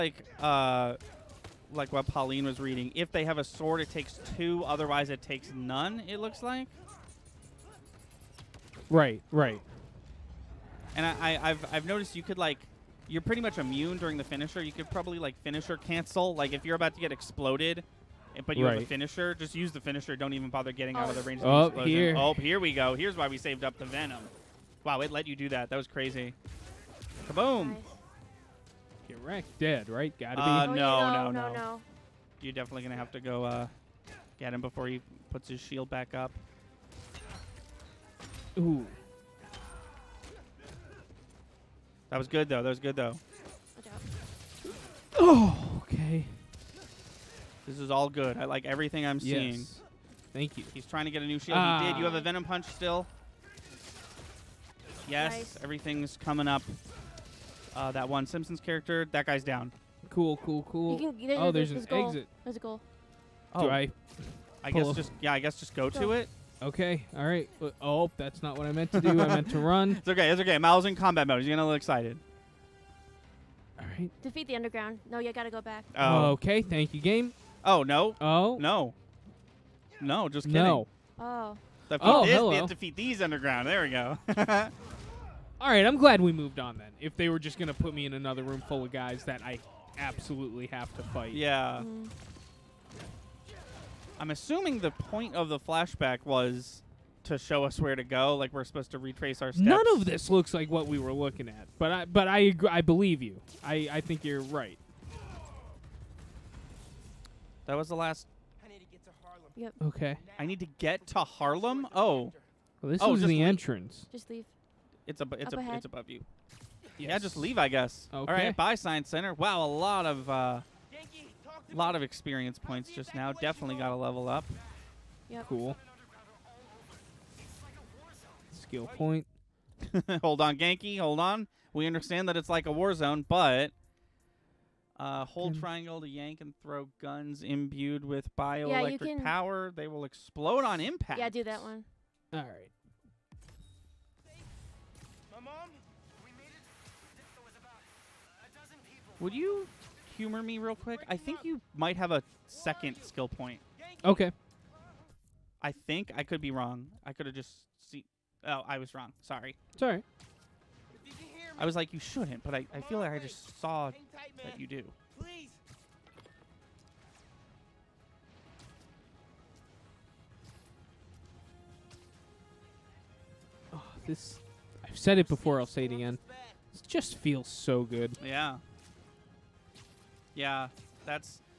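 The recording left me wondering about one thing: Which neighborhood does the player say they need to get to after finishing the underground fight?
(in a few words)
Harlem.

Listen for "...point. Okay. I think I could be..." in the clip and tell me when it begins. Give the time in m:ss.
2:33.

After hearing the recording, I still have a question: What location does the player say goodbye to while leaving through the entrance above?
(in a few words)
Science Center.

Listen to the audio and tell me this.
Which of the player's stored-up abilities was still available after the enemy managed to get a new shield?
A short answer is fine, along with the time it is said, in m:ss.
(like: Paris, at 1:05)
Venom Punch, at 0:52.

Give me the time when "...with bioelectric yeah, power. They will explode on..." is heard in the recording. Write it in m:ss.
2:18.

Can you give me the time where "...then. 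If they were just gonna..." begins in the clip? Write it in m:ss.
1:26.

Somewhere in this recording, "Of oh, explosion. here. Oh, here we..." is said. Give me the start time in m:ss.
0:21.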